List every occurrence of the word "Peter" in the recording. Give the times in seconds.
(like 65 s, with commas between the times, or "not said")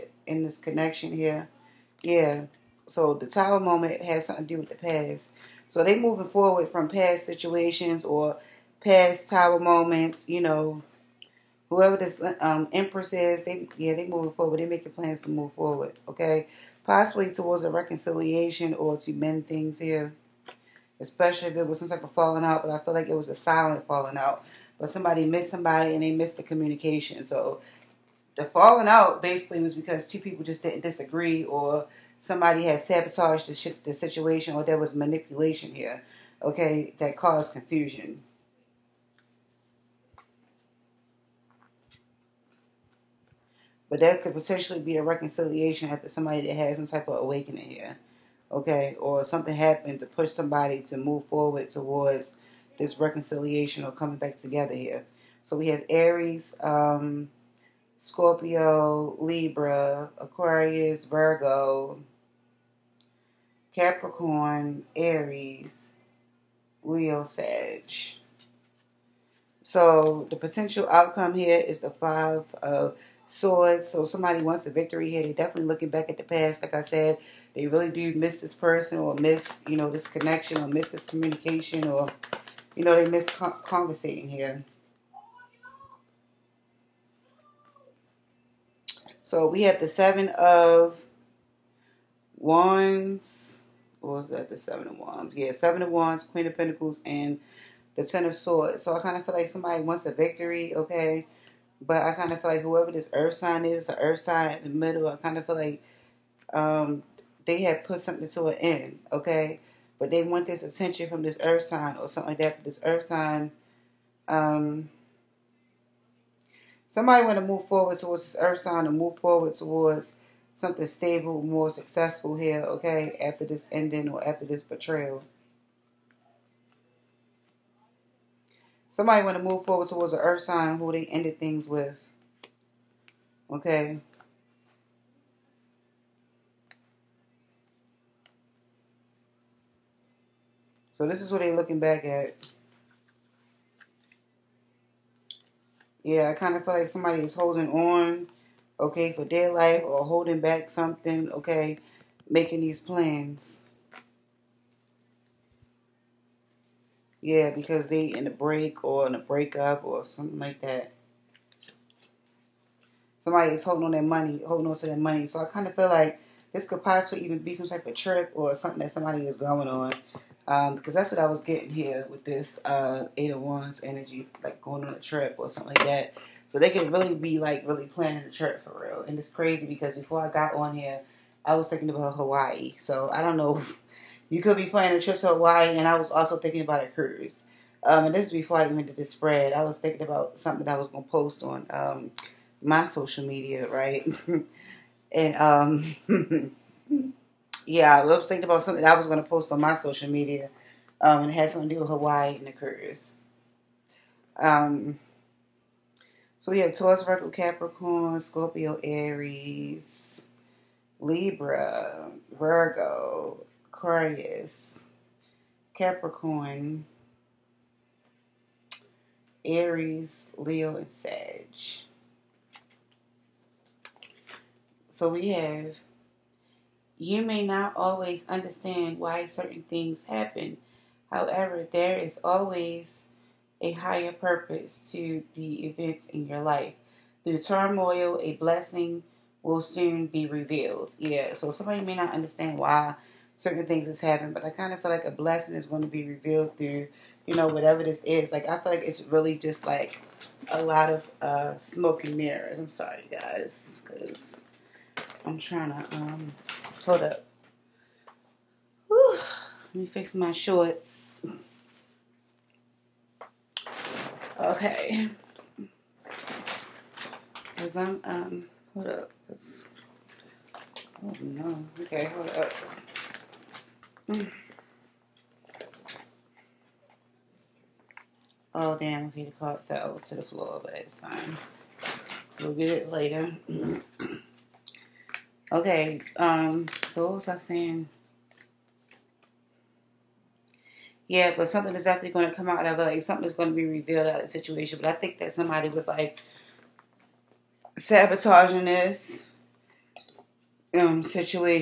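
279 s.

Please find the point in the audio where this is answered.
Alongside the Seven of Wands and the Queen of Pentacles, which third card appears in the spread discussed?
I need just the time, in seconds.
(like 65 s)
98 s.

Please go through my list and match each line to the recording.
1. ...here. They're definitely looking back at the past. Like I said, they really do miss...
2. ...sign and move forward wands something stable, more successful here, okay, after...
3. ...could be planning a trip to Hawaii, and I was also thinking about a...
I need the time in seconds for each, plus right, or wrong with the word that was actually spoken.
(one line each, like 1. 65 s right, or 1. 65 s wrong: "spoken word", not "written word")
1. 75 s right
2. 118 s wrong: "towards", not "wands"
3. 184 s right.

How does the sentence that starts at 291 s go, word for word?
Yeah, but something is definitely going to come out of it.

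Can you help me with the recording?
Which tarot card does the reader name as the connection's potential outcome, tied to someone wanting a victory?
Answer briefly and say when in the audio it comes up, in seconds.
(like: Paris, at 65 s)
Five of Swords, at 71 s.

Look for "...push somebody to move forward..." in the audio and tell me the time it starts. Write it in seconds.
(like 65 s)
50 s.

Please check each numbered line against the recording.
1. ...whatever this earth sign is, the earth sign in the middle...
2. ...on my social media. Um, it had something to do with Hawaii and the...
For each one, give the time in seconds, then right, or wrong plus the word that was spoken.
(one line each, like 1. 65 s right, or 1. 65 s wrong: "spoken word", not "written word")
1. 102 s wrong: "whoever", not "whatever"
2. 199 s right.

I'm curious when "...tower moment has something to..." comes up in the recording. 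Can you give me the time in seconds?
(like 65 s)
3 s.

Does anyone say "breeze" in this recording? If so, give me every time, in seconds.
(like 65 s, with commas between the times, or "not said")
not said.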